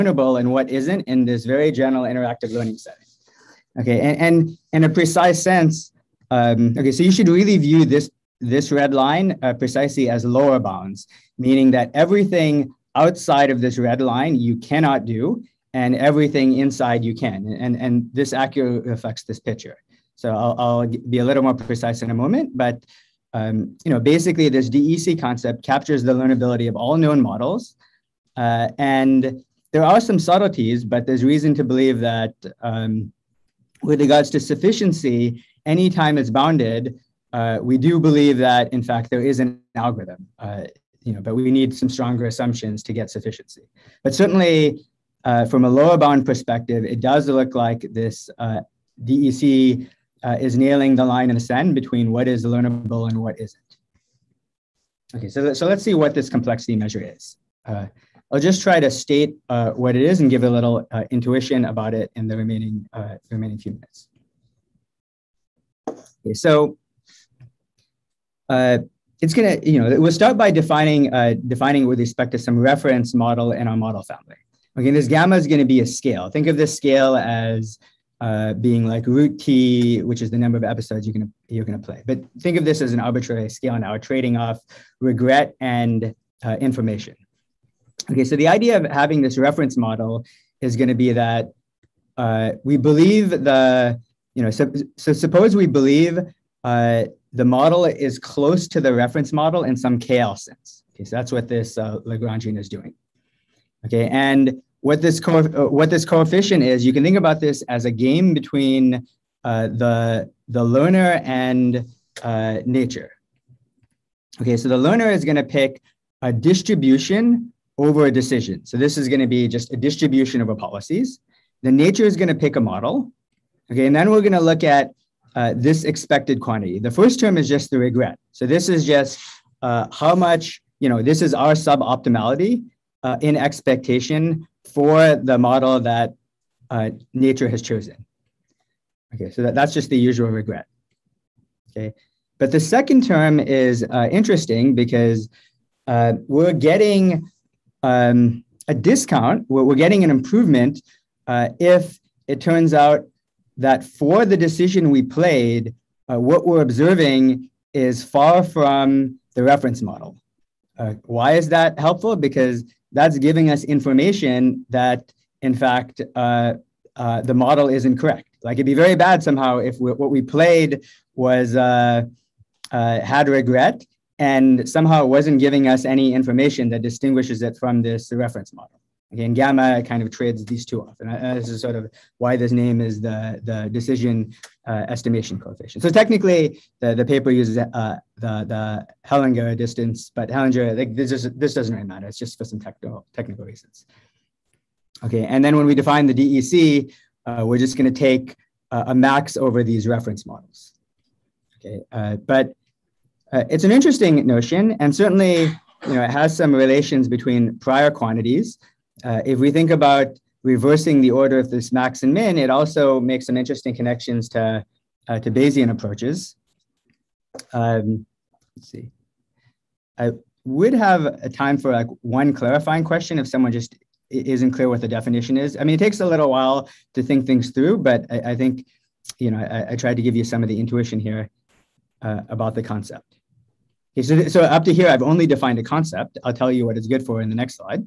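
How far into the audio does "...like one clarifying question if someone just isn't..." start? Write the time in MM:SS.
03:41.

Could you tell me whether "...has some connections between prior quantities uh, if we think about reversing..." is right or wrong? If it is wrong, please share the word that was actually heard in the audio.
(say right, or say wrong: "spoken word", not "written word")
wrong: "relations", not "connections".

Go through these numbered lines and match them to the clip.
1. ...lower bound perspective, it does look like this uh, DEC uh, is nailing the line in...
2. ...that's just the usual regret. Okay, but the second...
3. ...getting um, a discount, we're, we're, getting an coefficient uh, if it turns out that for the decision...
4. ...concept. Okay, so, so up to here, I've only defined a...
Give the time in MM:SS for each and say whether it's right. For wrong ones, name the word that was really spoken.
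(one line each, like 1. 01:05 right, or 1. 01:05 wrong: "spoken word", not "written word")
1. 00:45 right
2. 02:19 right
3. 02:26 wrong: "improvement", not "coefficient"
4. 03:52 right.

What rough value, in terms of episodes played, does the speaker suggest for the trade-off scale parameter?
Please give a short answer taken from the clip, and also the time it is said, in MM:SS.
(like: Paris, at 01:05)
root t, at 01:19.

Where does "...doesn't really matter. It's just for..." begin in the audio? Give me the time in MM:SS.
03:11.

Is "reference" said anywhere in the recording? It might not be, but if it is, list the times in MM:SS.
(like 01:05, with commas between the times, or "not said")
01:12, 01:29, 01:38, 02:39, 02:58, 03:19.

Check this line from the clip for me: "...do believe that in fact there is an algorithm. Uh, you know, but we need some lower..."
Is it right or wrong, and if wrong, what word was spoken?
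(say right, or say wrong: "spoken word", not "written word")
wrong: "stronger", not "lower".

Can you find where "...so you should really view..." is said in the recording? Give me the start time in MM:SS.
00:06.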